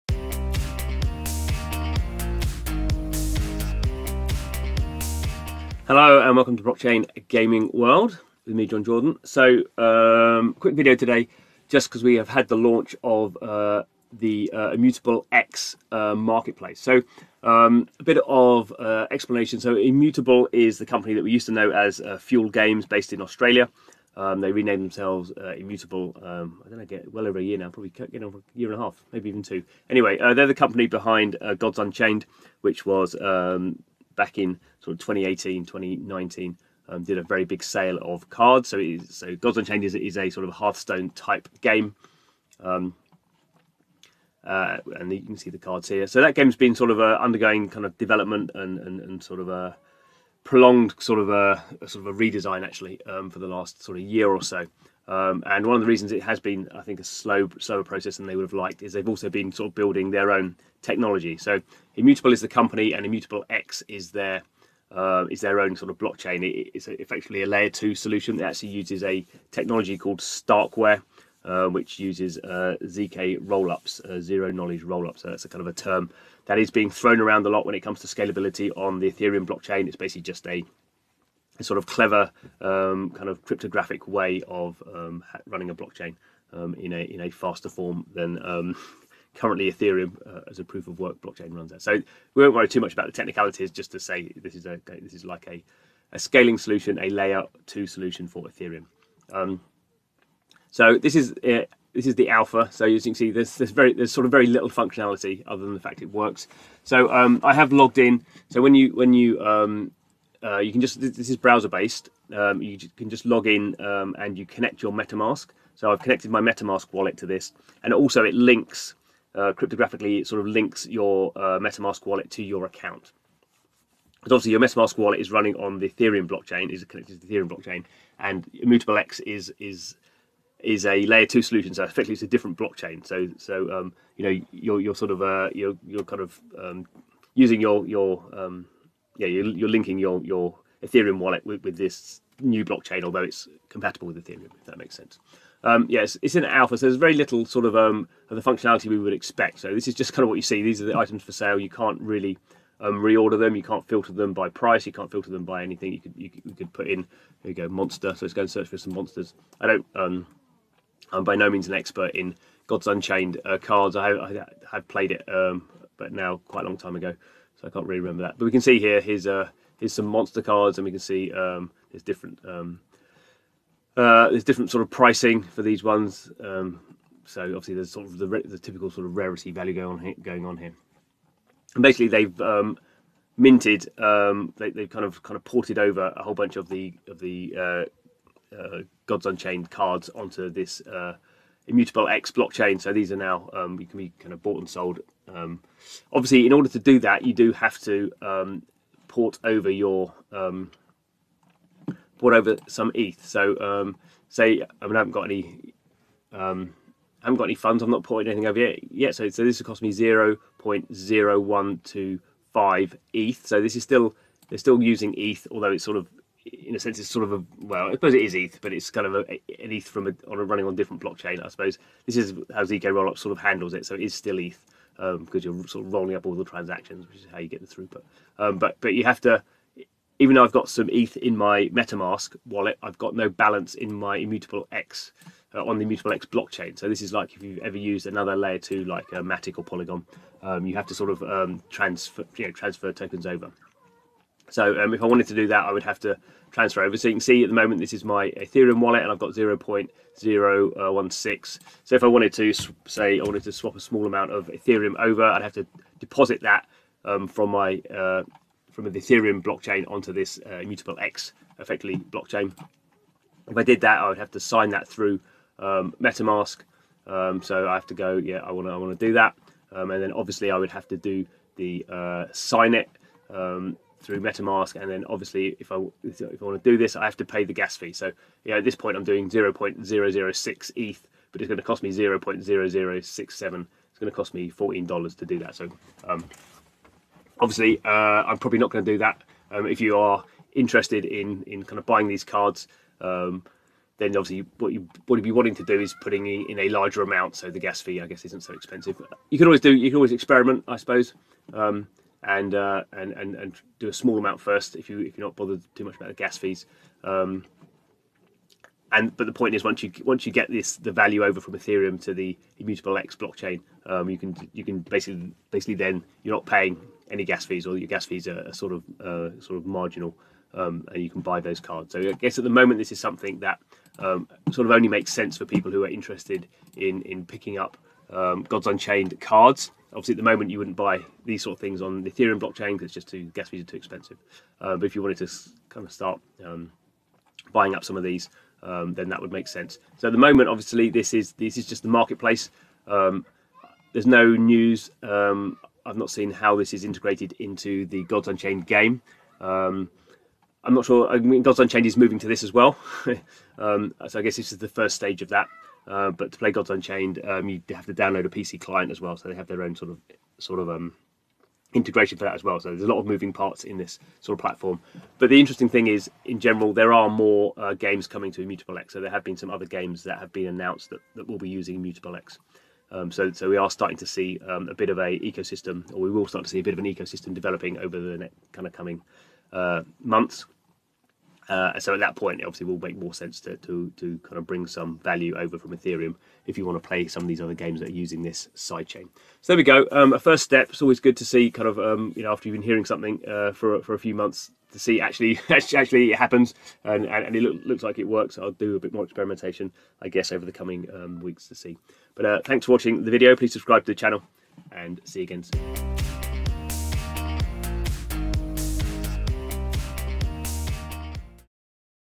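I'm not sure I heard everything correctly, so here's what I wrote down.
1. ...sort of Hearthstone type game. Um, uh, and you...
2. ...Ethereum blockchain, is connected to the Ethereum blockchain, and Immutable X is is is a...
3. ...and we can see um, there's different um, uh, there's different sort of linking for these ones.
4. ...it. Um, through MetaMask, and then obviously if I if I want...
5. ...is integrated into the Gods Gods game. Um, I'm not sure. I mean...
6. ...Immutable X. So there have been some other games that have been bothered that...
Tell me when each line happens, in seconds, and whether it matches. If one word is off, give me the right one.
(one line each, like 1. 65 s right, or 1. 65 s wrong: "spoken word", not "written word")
1. 40 s right
2. 125 s right
3. 170 s wrong: "pricing", not "linking"
4. 272 s right
5. 346 s wrong: "Unchained", not "Gods"
6. 368 s wrong: "announced", not "bothered".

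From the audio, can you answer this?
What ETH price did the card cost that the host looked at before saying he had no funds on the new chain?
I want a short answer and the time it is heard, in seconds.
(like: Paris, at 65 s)
0.0125 ETH, at 209 s.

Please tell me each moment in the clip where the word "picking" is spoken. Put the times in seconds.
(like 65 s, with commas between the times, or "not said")
327 s.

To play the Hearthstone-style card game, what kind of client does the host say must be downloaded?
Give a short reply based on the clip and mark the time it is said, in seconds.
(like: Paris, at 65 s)
PC client, at 358 s.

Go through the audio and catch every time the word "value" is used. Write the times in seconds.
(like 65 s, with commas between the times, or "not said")
179 s, 310 s, 384 s.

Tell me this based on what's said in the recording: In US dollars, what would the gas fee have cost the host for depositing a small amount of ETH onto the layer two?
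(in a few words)
$14.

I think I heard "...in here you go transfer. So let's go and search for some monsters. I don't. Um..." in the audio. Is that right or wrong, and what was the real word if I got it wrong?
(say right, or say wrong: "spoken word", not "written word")
wrong: "monster", not "transfer".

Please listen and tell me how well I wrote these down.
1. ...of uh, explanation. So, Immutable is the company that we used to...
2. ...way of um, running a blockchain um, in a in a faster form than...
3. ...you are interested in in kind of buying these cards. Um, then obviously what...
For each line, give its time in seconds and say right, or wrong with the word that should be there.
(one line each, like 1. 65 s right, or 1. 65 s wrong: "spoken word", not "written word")
1. 18 s right
2. 84 s right
3. 289 s right.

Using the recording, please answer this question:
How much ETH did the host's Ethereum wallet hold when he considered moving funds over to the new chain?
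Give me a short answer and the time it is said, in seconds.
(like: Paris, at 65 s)
0.016, at 249 s.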